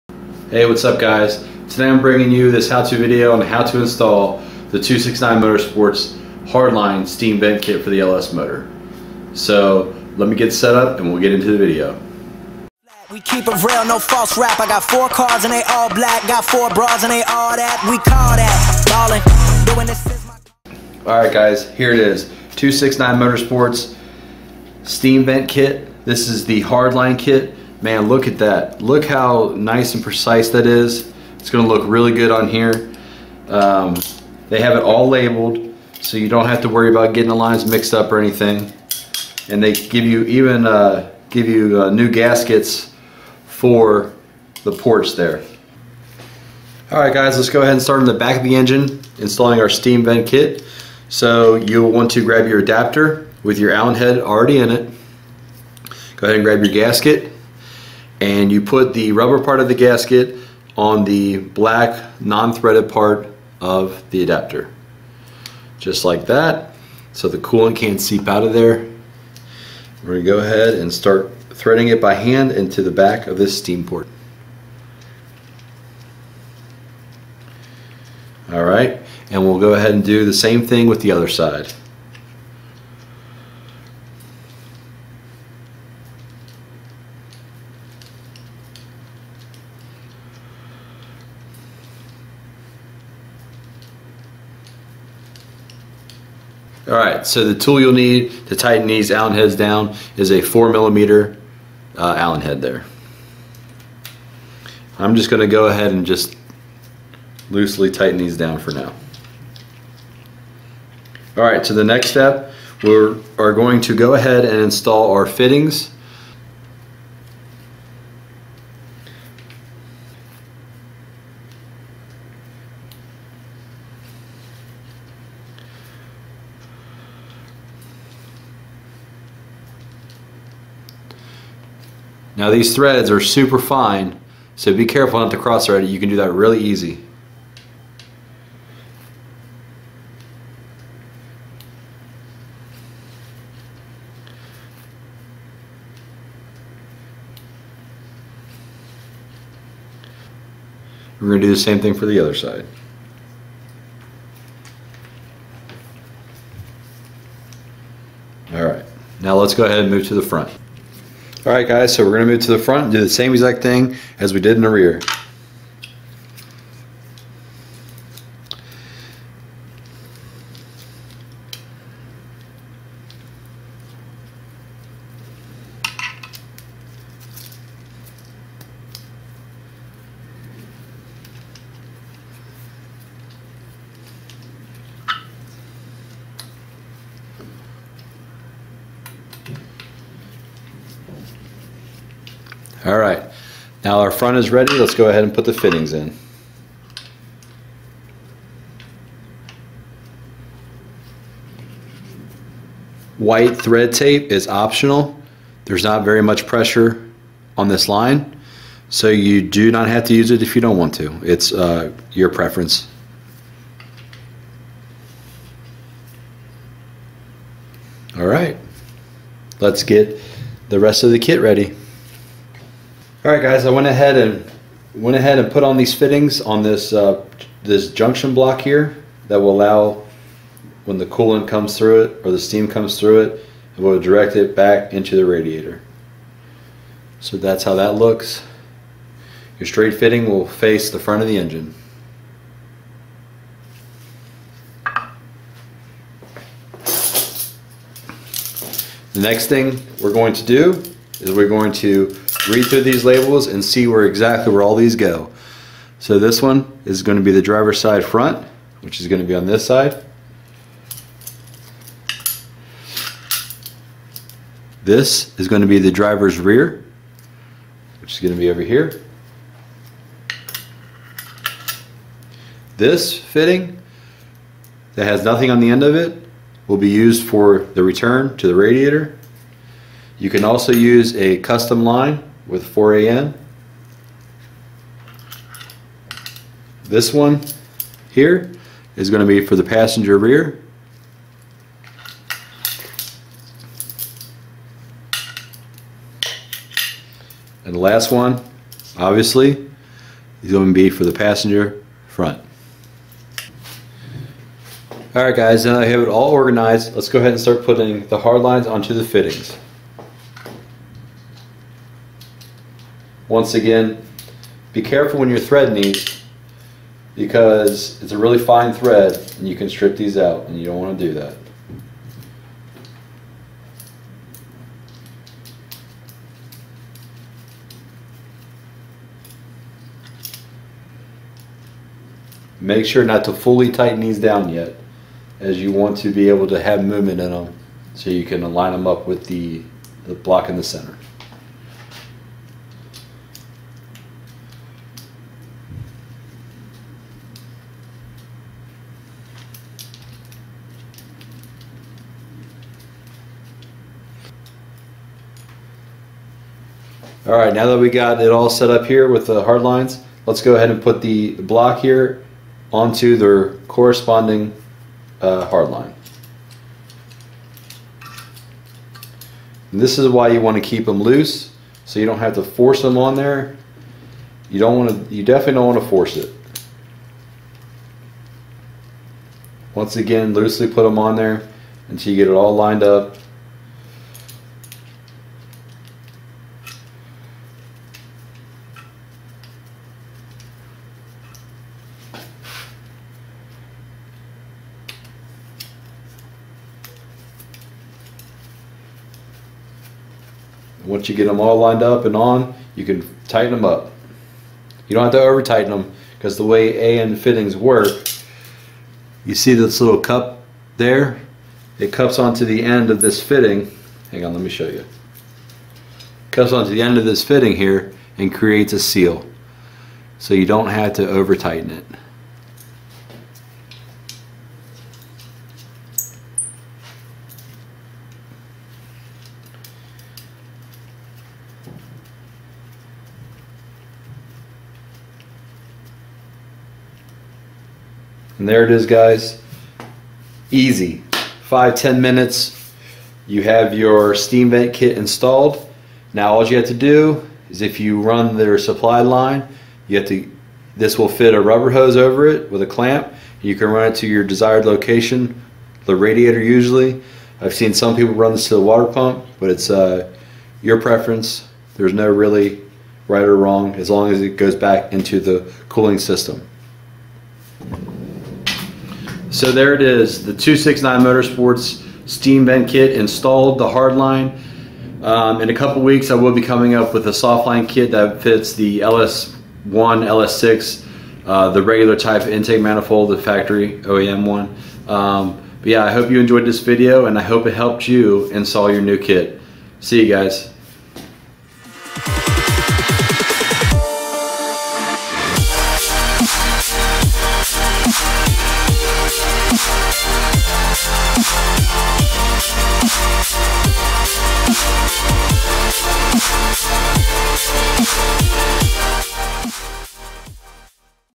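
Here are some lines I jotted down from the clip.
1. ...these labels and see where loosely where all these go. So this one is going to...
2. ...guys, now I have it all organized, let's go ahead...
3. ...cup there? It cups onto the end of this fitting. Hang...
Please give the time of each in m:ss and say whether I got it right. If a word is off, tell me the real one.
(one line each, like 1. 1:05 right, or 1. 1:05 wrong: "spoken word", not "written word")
1. 4:12 wrong: "exactly", not "loosely"
2. 5:05 right
3. 6:49 right.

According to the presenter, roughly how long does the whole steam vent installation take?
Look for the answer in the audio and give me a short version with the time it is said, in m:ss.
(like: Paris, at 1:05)
5 to 10 minutes, at 7:21.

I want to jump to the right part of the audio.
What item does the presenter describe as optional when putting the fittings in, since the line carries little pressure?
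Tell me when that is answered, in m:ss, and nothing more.
3:23.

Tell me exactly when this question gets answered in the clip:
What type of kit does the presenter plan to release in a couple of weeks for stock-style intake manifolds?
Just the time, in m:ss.
7:57.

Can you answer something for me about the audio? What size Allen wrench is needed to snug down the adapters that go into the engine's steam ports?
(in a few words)
4 millimeter.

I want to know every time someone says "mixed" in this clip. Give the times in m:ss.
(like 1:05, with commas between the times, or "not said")
0:37.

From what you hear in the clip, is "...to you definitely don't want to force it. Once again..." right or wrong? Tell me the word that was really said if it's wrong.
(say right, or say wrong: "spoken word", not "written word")
right.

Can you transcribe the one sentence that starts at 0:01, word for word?
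Today I'm bringing you this how-to video on how to install the 269 Motorsports Hardline Steam Vent Kit for the LS motor.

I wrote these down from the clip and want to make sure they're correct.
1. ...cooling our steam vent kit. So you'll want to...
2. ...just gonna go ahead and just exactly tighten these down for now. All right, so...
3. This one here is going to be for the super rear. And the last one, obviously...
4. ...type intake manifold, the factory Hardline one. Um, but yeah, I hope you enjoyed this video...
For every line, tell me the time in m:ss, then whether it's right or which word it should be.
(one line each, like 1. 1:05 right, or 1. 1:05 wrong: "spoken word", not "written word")
1. 0:49 wrong: "installing", not "cooling"
2. 1:45 wrong: "loosely", not "exactly"
3. 4:46 wrong: "passenger", not "super"
4. 8:01 wrong: "OEM", not "Hardline".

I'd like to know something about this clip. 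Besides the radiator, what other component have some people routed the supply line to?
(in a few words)
Water pump.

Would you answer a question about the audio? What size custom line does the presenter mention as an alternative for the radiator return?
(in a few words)
4AN.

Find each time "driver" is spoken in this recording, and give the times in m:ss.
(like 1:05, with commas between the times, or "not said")
4:17, 4:25.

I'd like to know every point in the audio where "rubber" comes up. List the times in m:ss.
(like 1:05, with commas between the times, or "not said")
0:59, 7:31.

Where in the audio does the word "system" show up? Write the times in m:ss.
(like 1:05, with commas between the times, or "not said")
7:45.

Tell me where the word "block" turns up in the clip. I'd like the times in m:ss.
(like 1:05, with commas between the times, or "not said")
3:48, 5:40, 6:01.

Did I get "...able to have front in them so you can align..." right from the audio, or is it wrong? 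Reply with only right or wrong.
wrong.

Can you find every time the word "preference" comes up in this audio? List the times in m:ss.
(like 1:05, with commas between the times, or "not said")
3:32, 7:40.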